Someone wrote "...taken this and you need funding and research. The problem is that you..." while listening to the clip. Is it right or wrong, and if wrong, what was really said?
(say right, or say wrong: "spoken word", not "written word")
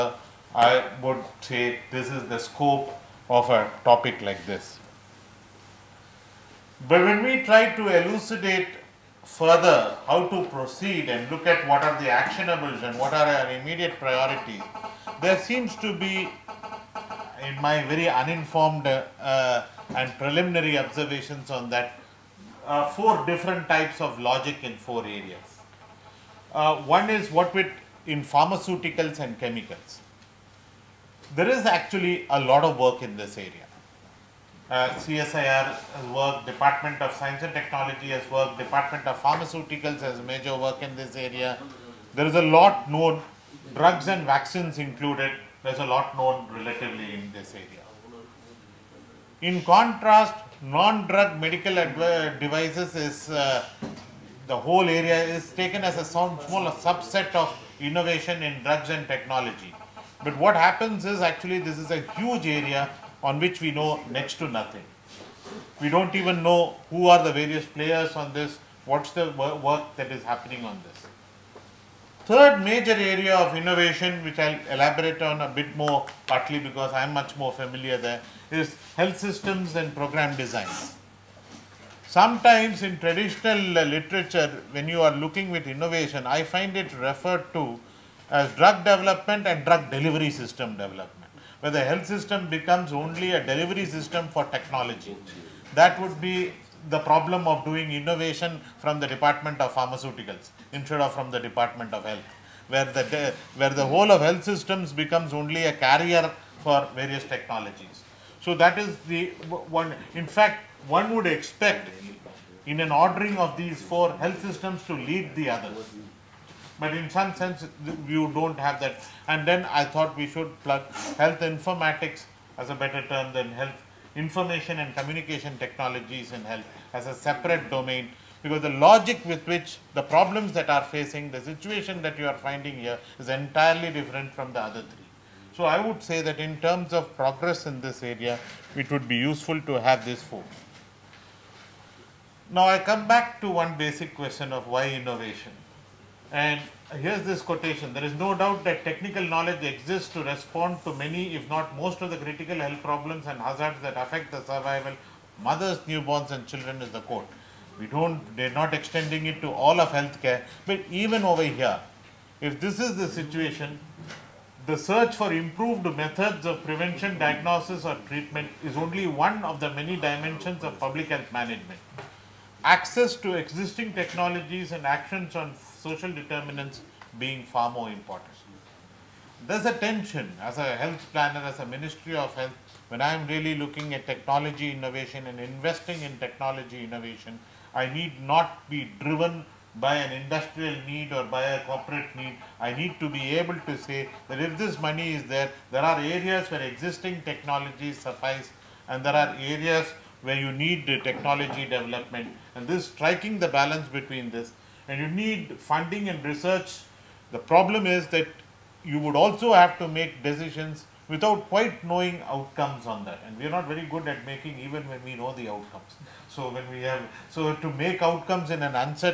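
wrong: "between", not "taken".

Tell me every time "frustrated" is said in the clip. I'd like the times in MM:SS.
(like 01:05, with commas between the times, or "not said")
not said.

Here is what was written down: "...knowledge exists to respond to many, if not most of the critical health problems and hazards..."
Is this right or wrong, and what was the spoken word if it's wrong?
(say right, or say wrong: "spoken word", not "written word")
right.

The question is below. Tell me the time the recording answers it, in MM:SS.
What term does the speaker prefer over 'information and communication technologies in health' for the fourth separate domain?
02:01.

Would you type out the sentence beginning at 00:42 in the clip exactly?
There is a lot known, drugs and vaccines included, there's a lot known relatively in this area.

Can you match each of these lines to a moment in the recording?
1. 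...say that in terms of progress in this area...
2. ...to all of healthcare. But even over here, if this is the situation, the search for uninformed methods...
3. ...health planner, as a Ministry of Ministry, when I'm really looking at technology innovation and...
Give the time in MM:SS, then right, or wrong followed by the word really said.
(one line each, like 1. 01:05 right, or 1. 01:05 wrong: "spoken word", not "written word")
1. 02:16 right
2. 02:39 wrong: "improved", not "uninformed"
3. 03:00 wrong: "Health", not "Ministry".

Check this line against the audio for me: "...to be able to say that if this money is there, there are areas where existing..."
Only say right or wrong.
right.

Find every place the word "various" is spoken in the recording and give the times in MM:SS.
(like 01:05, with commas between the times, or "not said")
01:07, 01:46.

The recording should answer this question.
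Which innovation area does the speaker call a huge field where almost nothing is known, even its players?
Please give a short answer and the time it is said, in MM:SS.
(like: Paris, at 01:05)
Non-drug medical devices, at 00:50.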